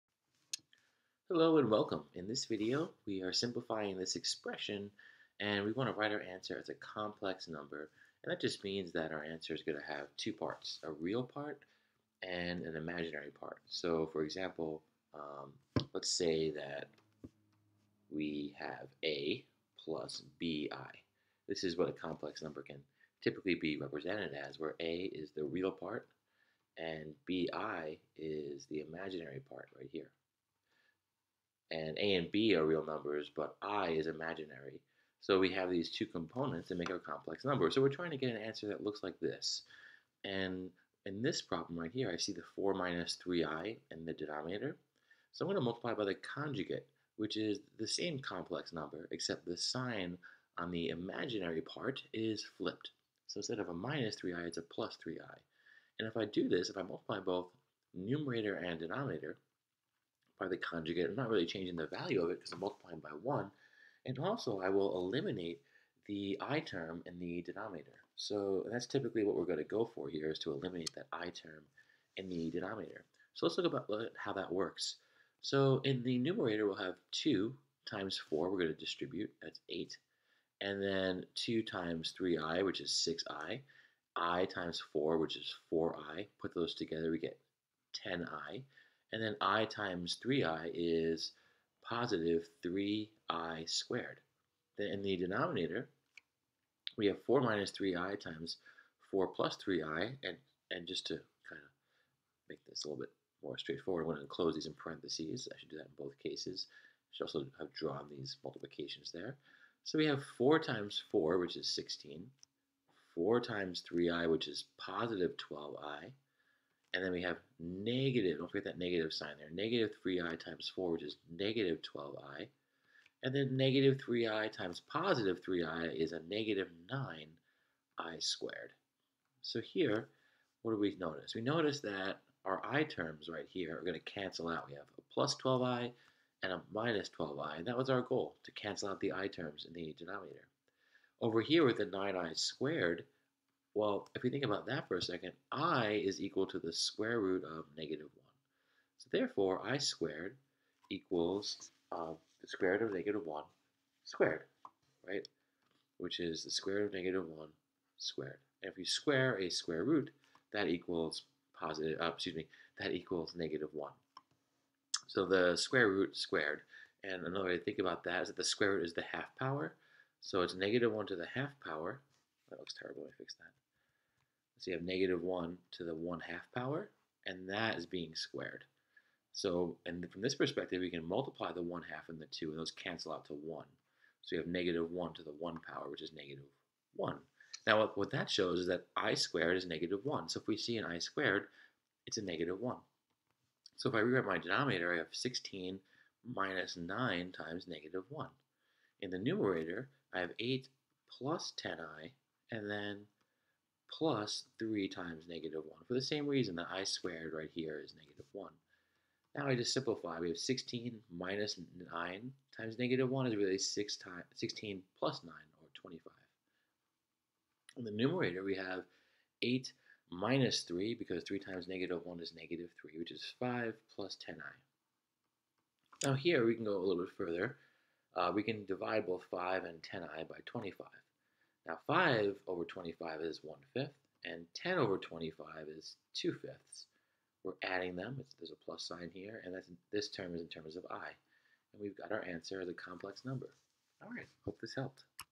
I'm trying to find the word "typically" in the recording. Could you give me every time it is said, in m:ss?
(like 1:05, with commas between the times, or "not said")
0:23, 1:08.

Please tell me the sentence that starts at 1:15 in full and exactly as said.
So in the numerator, we'll have 2 times 4.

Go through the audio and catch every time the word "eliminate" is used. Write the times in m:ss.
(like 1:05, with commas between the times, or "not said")
1:04, 1:10.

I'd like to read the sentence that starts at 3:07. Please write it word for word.
Now, what, what that shows is that i squared is negative 1.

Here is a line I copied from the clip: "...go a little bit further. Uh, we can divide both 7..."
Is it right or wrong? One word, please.
wrong.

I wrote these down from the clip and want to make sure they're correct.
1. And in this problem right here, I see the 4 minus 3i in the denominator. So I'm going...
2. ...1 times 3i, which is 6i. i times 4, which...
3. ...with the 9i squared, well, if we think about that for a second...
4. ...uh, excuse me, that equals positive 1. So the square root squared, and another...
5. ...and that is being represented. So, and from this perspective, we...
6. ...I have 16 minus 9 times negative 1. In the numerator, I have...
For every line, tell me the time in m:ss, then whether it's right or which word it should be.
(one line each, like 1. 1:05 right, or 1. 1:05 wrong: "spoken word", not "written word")
1. 0:40 right
2. 1:21 wrong: "2", not "1"
3. 2:21 right
4. 2:42 wrong: "negative", not "positive"
5. 2:57 wrong: "squared", not "represented"
6. 3:14 right.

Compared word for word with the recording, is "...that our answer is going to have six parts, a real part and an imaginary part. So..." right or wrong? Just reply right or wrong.
wrong.